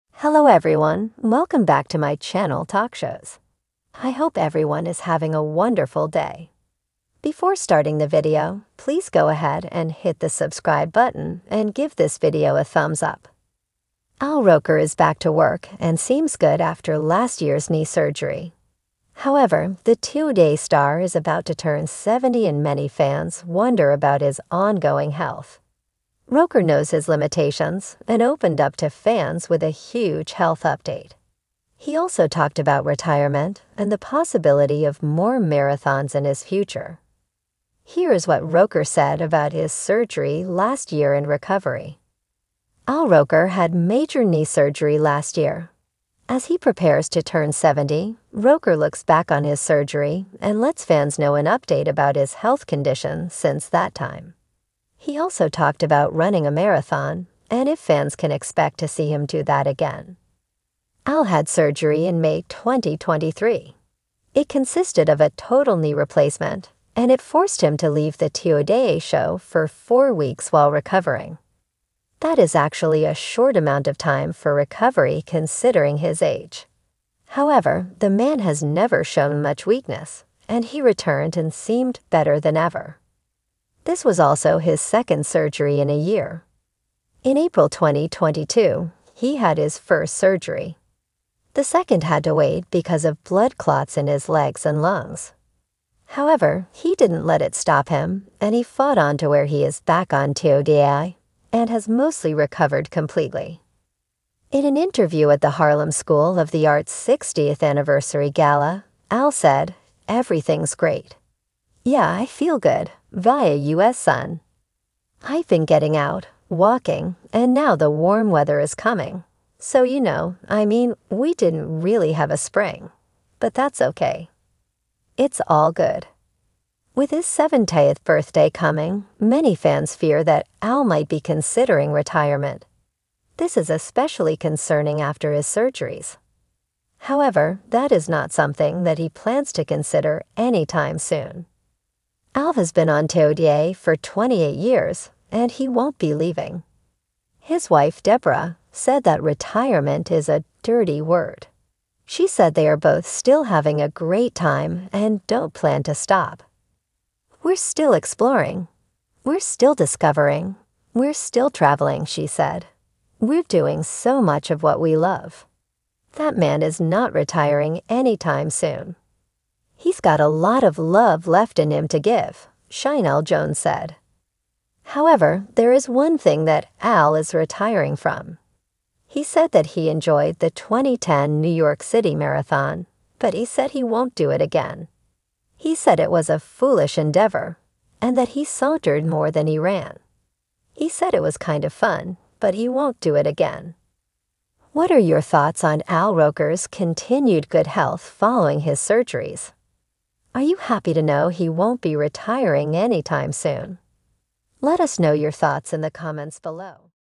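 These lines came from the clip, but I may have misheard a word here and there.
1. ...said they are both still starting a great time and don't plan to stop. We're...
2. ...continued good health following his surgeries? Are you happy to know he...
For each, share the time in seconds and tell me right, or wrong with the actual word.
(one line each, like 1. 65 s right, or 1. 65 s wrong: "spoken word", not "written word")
1. 152 s wrong: "having", not "starting"
2. 196 s right.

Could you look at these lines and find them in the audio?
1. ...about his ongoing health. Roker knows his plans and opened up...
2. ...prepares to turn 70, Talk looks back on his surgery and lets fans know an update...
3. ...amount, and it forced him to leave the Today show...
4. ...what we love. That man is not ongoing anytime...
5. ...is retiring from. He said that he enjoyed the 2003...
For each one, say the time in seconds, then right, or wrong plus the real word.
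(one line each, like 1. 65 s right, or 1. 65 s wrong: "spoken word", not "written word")
1. 23 s wrong: "limitations", not "plans"
2. 46 s wrong: "Roker", not "Talk"
3. 65 s wrong: "replacement", not "amount"
4. 164 s wrong: "retiring", not "ongoing"
5. 177 s wrong: "2010", not "2003".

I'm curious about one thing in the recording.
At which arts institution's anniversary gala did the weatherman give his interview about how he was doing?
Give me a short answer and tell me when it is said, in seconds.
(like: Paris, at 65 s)
Harlem School of the Arts, at 105 s.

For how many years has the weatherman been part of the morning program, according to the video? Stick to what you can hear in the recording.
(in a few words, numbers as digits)
28 years.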